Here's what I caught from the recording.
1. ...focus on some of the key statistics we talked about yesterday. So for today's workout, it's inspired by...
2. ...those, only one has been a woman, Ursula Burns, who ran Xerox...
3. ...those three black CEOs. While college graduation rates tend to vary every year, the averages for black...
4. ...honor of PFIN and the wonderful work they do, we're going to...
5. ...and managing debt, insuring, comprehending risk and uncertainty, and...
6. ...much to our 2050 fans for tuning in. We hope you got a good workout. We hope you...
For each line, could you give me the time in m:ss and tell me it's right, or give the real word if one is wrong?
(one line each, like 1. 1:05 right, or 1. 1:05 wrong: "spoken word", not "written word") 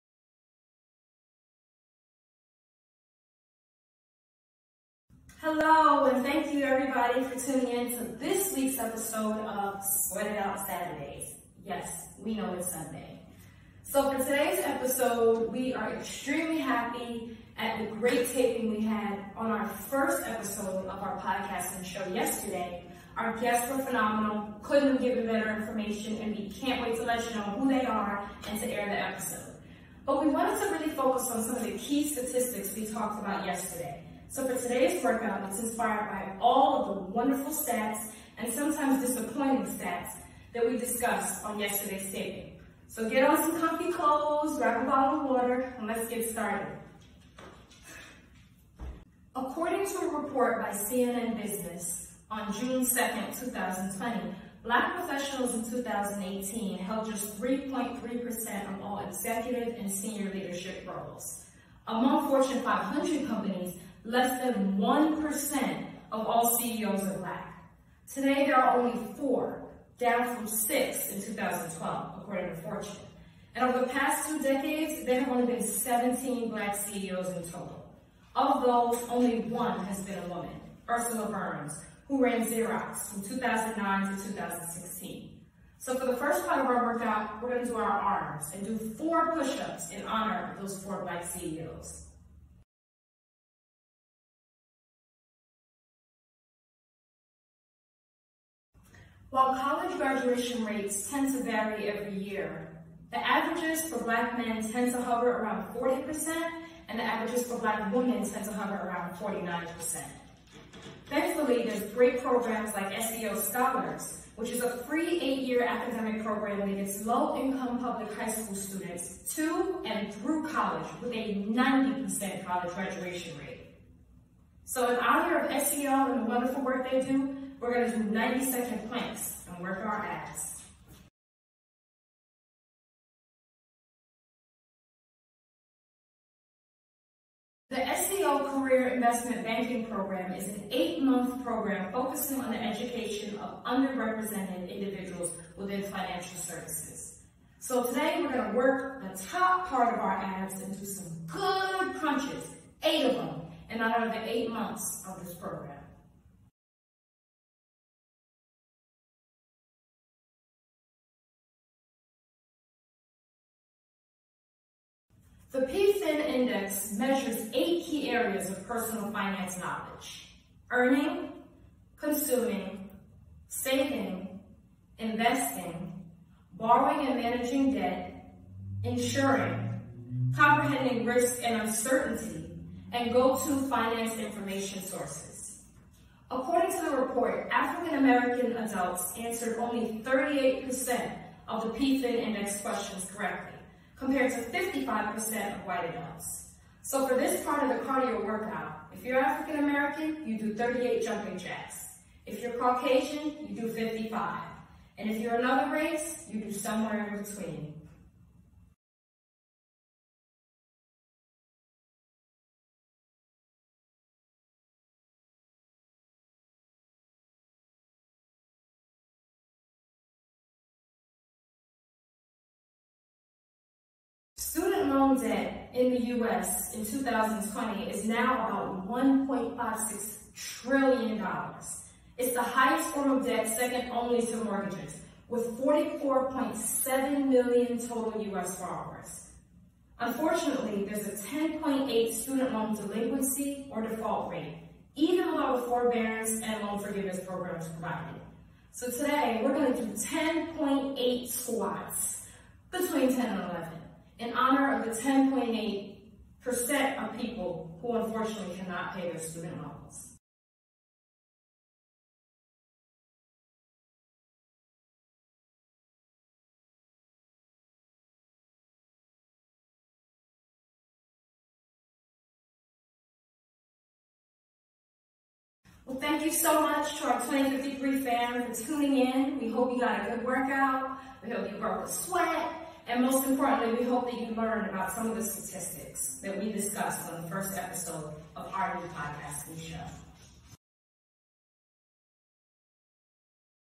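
1. 0:30 right
2. 1:18 right
3. 1:30 wrong: "four", not "three"
4. 2:04 wrong: "SEO", not "PFIN"
5. 2:57 right
6. 4:36 wrong: "2053", not "2050".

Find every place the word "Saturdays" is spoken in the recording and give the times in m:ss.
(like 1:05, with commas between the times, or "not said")
0:10.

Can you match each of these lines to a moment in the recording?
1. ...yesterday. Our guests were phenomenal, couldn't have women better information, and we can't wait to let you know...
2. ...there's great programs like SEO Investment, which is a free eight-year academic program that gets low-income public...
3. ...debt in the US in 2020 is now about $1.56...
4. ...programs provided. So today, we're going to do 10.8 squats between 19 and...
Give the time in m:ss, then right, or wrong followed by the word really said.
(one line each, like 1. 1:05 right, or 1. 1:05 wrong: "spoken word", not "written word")
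1. 0:22 wrong: "given", not "women"
2. 1:51 wrong: "Scholars", not "Investment"
3. 3:45 right
4. 4:07 wrong: "10", not "19".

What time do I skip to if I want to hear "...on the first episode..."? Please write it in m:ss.
4:47.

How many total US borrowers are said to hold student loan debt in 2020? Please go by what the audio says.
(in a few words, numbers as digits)
44.7 million.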